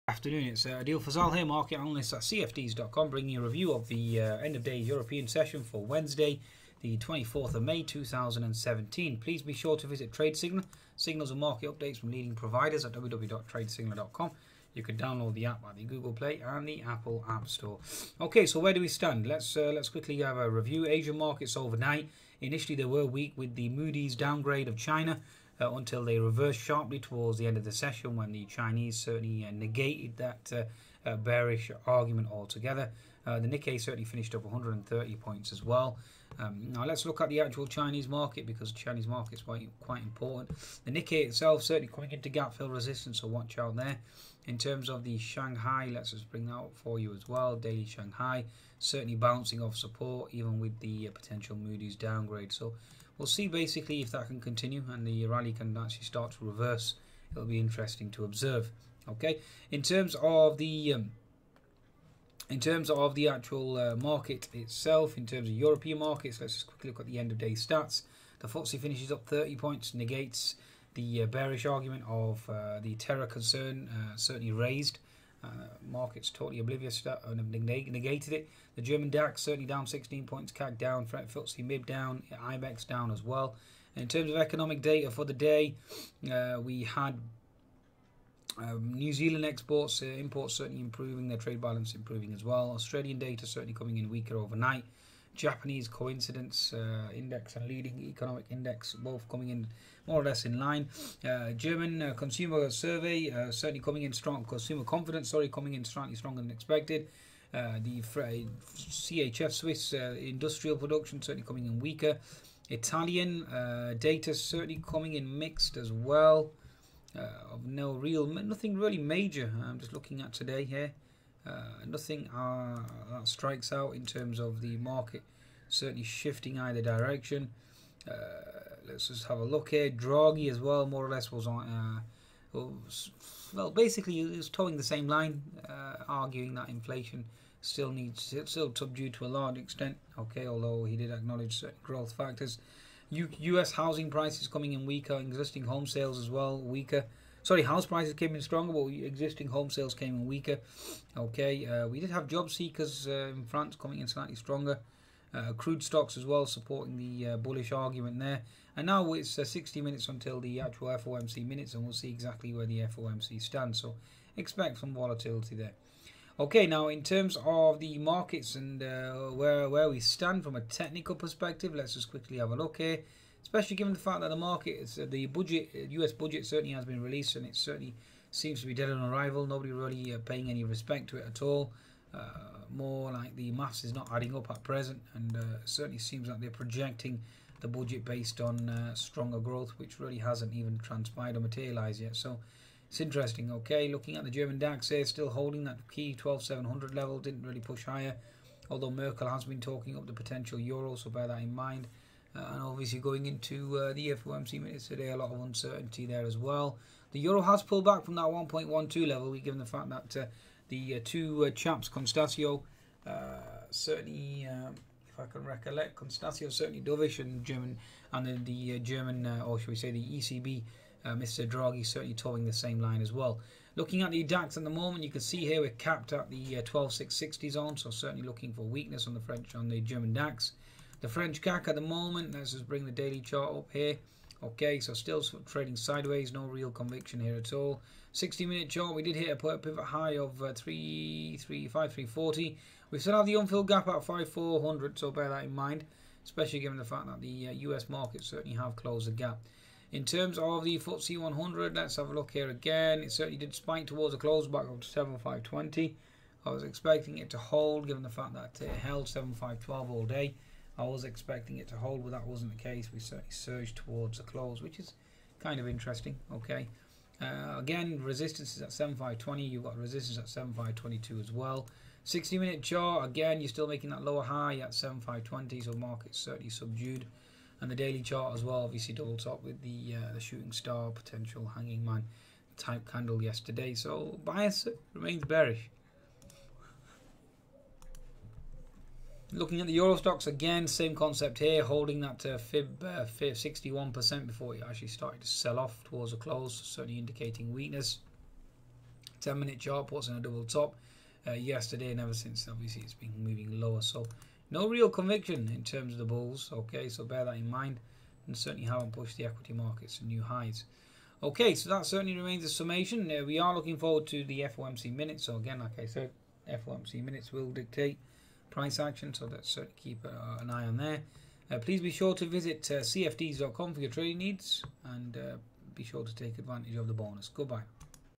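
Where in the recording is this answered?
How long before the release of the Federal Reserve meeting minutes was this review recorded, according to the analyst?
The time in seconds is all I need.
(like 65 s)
159 s.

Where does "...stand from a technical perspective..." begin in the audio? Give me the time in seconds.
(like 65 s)
169 s.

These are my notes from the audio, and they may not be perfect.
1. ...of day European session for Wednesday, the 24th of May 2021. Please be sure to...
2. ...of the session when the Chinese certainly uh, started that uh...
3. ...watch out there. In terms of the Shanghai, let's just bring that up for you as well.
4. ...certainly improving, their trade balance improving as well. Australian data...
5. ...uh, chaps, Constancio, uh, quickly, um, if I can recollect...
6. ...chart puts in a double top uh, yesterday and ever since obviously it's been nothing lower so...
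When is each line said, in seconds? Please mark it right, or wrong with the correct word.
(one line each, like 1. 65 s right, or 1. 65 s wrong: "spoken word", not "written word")
1. 4 s wrong: "2017", not "2021"
2. 27 s wrong: "negated", not "started"
3. 43 s right
4. 90 s right
5. 211 s wrong: "certainly", not "quickly"
6. 299 s wrong: "moving", not "nothing".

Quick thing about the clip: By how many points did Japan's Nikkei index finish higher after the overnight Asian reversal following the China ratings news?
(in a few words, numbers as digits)
130.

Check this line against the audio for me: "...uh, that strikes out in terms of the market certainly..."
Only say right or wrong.
right.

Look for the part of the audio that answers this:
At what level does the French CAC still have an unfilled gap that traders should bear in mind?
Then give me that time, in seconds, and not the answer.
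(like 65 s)
244 s.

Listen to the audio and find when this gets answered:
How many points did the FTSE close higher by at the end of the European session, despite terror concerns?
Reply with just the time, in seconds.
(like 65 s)
69 s.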